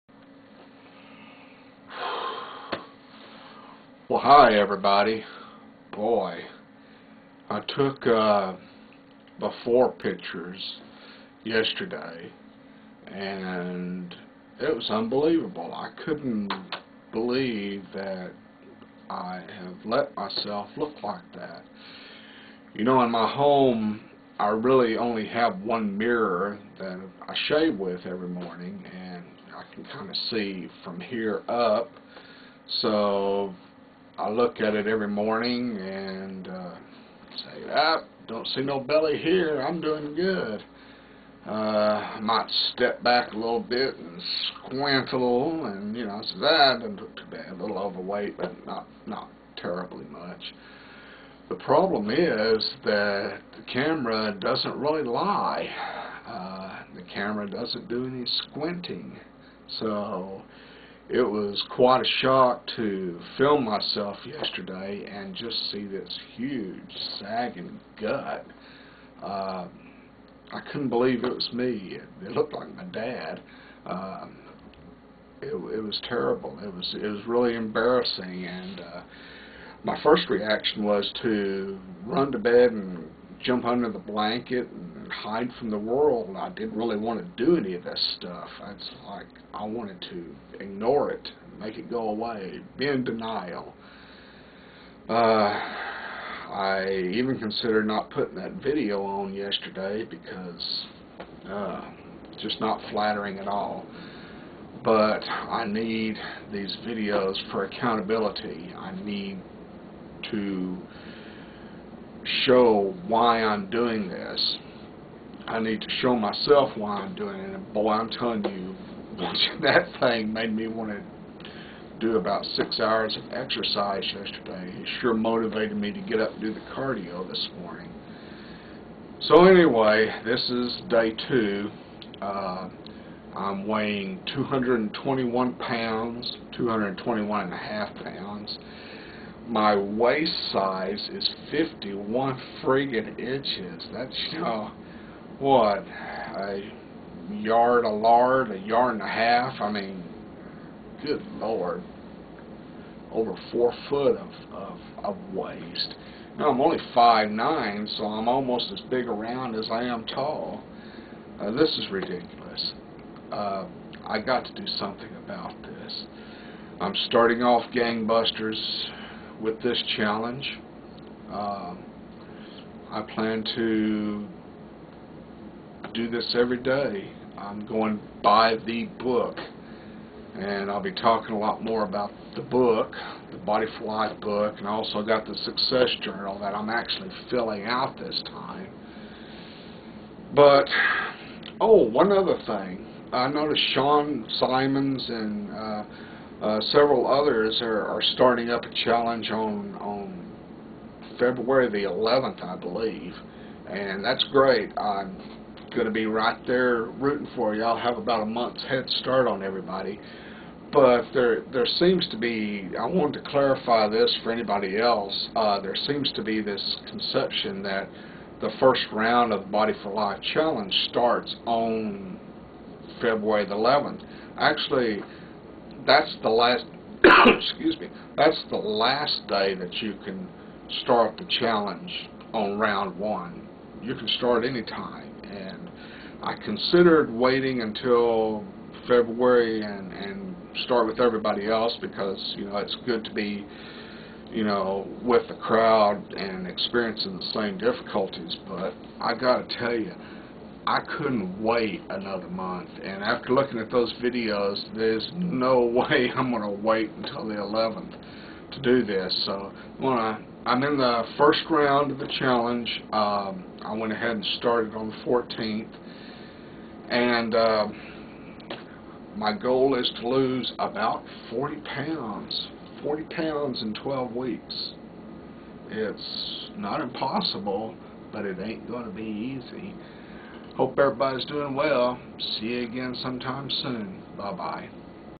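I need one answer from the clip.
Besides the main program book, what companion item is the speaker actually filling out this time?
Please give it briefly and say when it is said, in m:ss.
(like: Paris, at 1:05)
Success Journal, at 3:05.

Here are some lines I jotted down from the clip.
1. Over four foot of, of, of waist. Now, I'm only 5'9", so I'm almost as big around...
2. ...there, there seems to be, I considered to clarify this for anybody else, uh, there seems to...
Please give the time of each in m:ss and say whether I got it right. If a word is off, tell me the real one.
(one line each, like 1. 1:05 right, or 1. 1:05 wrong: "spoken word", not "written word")
1. 2:33 right
2. 3:31 wrong: "wanted", not "considered".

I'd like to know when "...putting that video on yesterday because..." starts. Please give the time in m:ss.
1:38.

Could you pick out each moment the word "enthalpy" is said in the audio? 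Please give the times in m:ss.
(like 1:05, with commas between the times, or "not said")
not said.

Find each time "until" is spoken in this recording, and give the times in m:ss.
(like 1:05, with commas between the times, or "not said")
3:57, 4:16.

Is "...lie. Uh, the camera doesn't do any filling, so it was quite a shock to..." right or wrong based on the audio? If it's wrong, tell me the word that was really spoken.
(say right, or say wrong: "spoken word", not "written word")
wrong: "squinting", not "filling".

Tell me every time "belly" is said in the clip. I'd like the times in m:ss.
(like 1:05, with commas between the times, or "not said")
0:38.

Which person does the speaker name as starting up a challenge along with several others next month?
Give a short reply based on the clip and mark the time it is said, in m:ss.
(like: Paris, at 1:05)
Sean Simons, at 3:13.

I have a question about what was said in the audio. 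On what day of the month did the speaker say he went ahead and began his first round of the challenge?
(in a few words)
14th.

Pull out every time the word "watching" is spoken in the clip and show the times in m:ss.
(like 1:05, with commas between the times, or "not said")
1:59.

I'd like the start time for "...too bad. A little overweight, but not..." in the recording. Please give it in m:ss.
0:47.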